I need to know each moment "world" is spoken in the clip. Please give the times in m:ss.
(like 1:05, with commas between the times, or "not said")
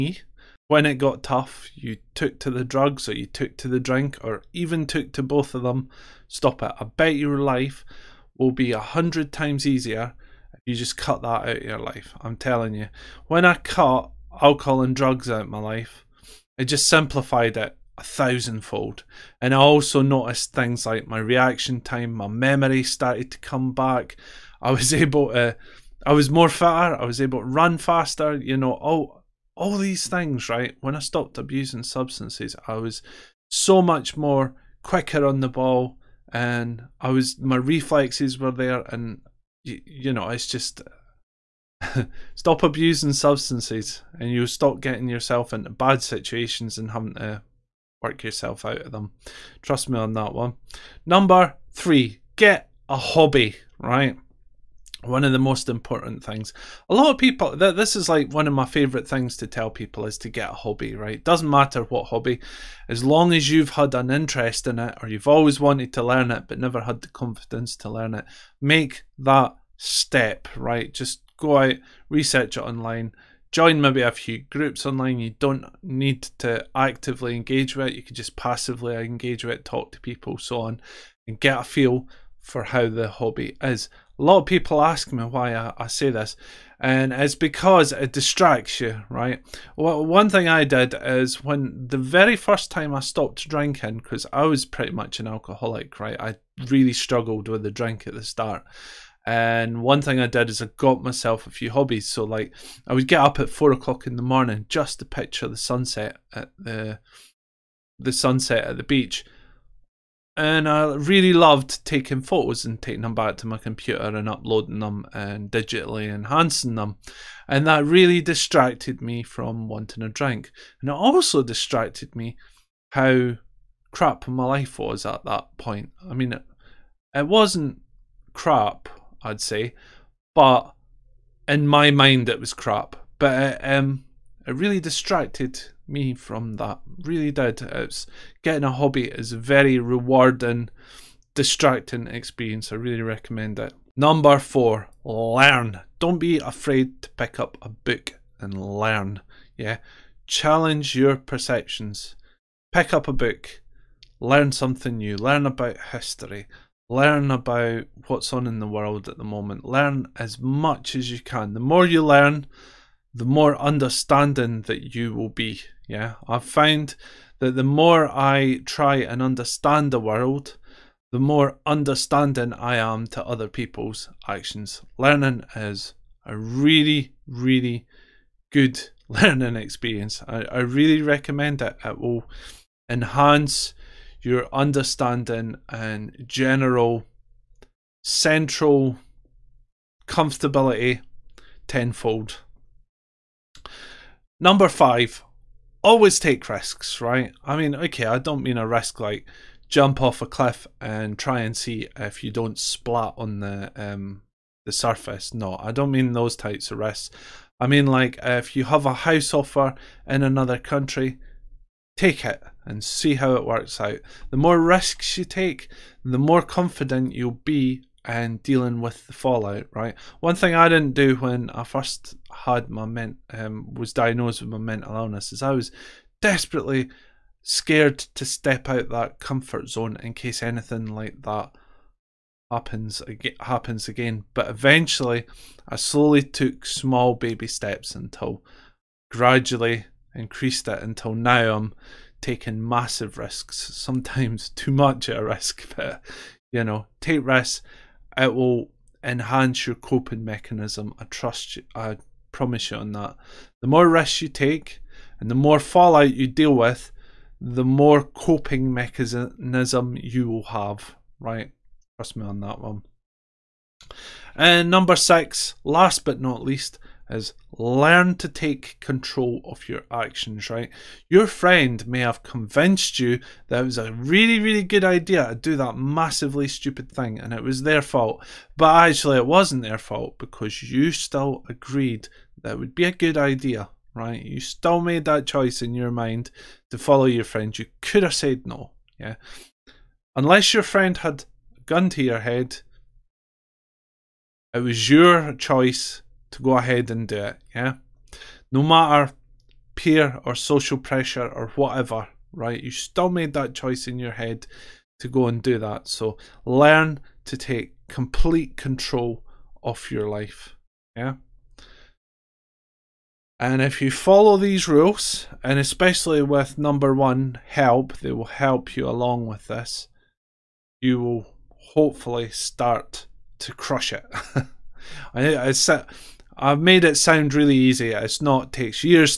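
2:38, 2:49.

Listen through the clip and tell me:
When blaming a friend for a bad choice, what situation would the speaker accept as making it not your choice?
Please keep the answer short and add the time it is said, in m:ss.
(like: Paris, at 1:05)
a gun to your head, at 4:51.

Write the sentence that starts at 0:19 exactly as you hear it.
And I also noticed things like my reaction time, my memory started to come back.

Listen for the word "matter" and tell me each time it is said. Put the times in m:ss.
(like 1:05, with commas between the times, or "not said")
1:01, 4:58.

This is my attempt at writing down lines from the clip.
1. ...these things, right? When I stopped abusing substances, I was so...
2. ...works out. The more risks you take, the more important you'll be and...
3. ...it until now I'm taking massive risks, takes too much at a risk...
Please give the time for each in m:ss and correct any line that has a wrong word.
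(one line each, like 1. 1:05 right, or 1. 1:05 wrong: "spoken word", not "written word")
1. 0:29 right
2. 3:33 wrong: "confident", not "important"
3. 4:00 wrong: "sometimes", not "takes".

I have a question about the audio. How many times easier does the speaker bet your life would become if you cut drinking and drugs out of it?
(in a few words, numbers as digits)
100.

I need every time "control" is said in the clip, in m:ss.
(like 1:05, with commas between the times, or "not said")
4:28, 5:08.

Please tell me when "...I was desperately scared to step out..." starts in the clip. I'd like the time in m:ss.
3:45.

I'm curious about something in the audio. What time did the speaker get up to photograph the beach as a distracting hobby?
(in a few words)
4 o'clock in the morning.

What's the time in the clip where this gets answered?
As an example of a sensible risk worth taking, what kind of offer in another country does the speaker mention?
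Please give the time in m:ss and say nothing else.
3:28.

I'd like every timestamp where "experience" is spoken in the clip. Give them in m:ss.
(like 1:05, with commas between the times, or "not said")
2:22, 2:59.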